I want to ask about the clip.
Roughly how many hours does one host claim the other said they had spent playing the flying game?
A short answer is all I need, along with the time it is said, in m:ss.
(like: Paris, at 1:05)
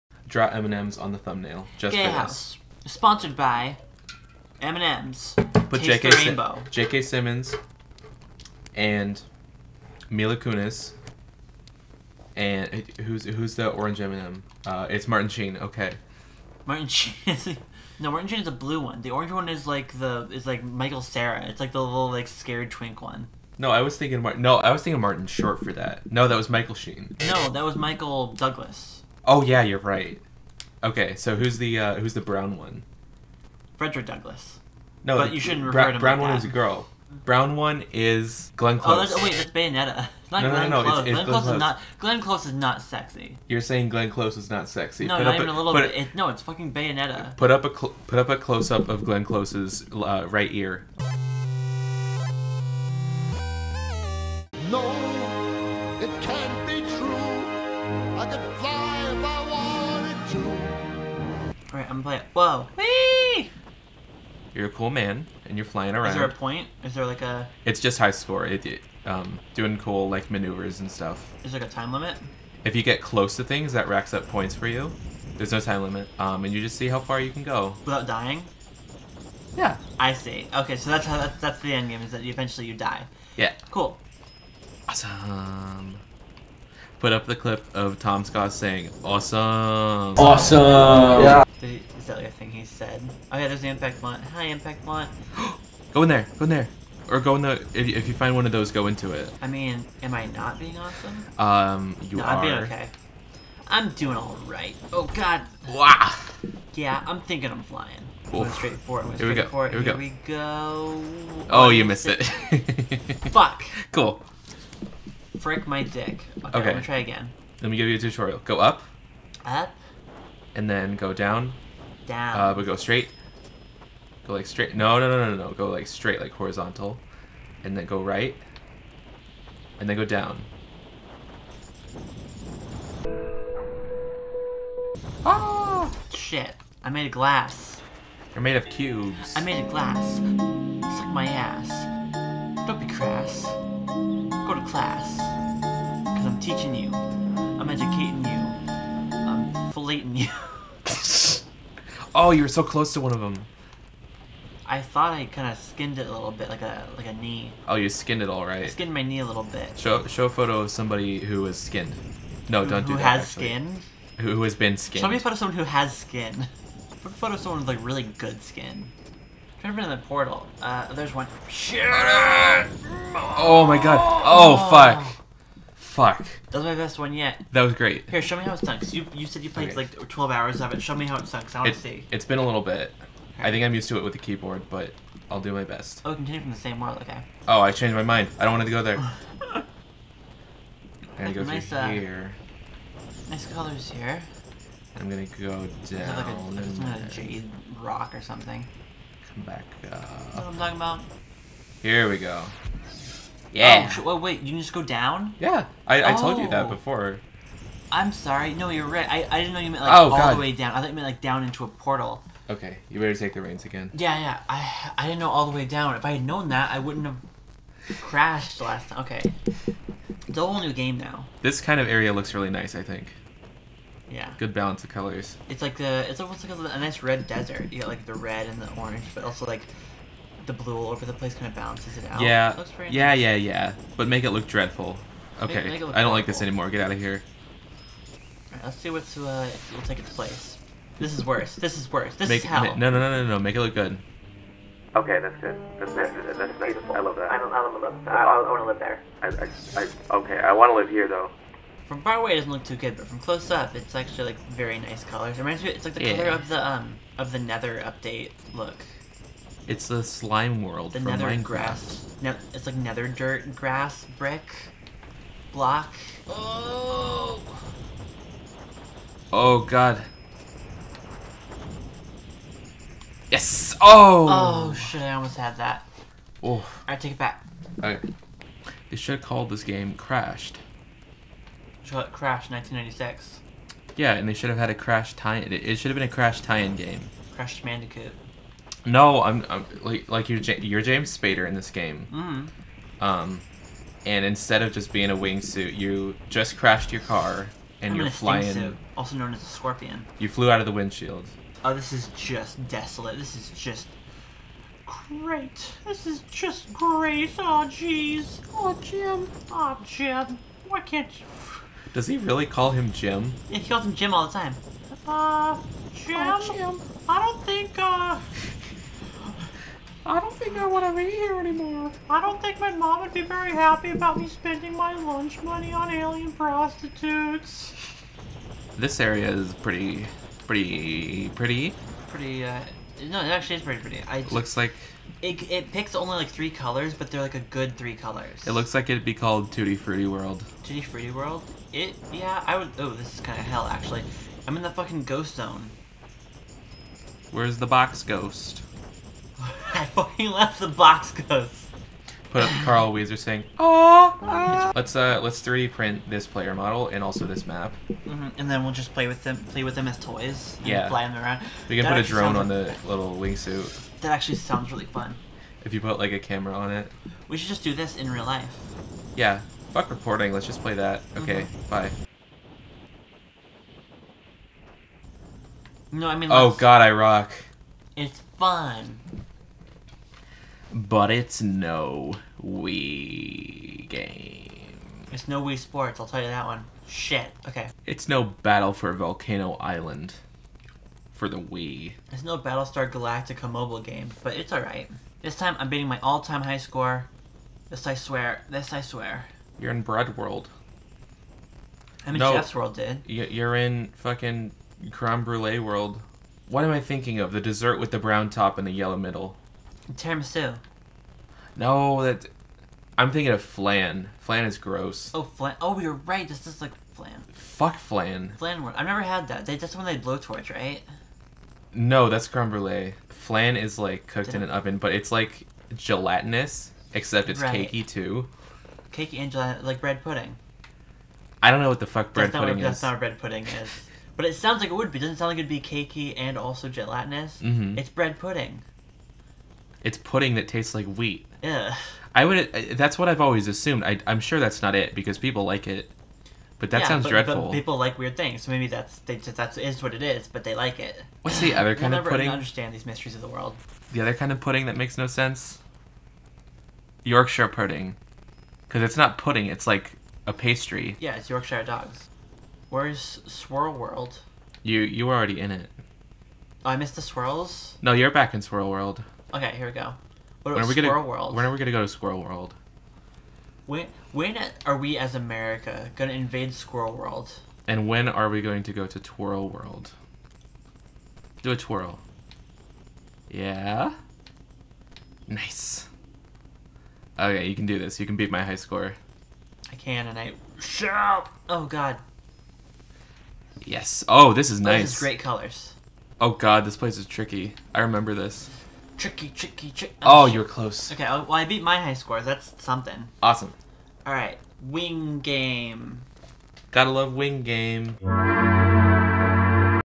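12, at 3:00.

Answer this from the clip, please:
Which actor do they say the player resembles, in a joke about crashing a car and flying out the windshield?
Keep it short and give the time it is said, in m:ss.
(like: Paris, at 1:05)
James Spader, at 4:50.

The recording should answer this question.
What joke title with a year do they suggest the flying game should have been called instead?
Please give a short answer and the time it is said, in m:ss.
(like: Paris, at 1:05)
Crashed 1996, at 4:42.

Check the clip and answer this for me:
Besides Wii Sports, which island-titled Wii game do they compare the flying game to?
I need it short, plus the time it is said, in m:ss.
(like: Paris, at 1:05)
Battle for Volcano Island, at 6:28.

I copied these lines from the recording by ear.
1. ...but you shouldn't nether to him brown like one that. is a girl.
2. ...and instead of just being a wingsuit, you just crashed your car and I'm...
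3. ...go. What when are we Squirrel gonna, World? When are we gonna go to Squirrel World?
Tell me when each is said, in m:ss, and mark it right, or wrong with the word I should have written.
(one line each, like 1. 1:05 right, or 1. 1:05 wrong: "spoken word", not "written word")
1. 0:35 wrong: "refer", not "nether"
2. 4:54 right
3. 7:49 right.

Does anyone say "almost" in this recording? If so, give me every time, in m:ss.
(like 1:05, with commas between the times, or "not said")
3:46, 4:35.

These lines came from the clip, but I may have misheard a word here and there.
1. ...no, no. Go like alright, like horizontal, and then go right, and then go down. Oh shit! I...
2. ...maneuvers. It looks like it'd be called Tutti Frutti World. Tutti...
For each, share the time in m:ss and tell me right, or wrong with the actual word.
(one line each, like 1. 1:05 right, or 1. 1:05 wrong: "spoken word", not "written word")
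1. 2:05 wrong: "straight", not "alright"
2. 5:37 wrong: "colors", not "maneuvers".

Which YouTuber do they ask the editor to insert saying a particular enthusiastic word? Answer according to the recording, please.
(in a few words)
Tom Scott.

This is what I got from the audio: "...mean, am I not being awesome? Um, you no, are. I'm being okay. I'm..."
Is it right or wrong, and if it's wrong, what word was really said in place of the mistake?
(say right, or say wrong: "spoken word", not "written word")
right.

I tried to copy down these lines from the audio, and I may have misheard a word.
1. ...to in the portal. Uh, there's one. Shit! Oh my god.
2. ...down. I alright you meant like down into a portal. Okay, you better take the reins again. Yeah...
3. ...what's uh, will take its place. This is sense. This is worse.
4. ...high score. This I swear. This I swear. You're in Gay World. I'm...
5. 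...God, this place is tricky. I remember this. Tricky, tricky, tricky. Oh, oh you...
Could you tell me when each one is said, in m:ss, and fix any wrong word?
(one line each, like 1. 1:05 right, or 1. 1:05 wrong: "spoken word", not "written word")
1. 2:49 right
2. 3:30 wrong: "thought", not "alright"
3. 3:58 wrong: "worse", not "sense"
4. 6:36 wrong: "Bread", not "Gay"
5. 8:16 right.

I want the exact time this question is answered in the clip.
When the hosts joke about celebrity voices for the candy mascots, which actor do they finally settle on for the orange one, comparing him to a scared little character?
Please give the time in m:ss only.
0:20.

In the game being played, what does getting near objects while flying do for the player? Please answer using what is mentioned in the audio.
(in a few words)
racks up points.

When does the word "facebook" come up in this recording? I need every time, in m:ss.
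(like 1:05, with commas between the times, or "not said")
not said.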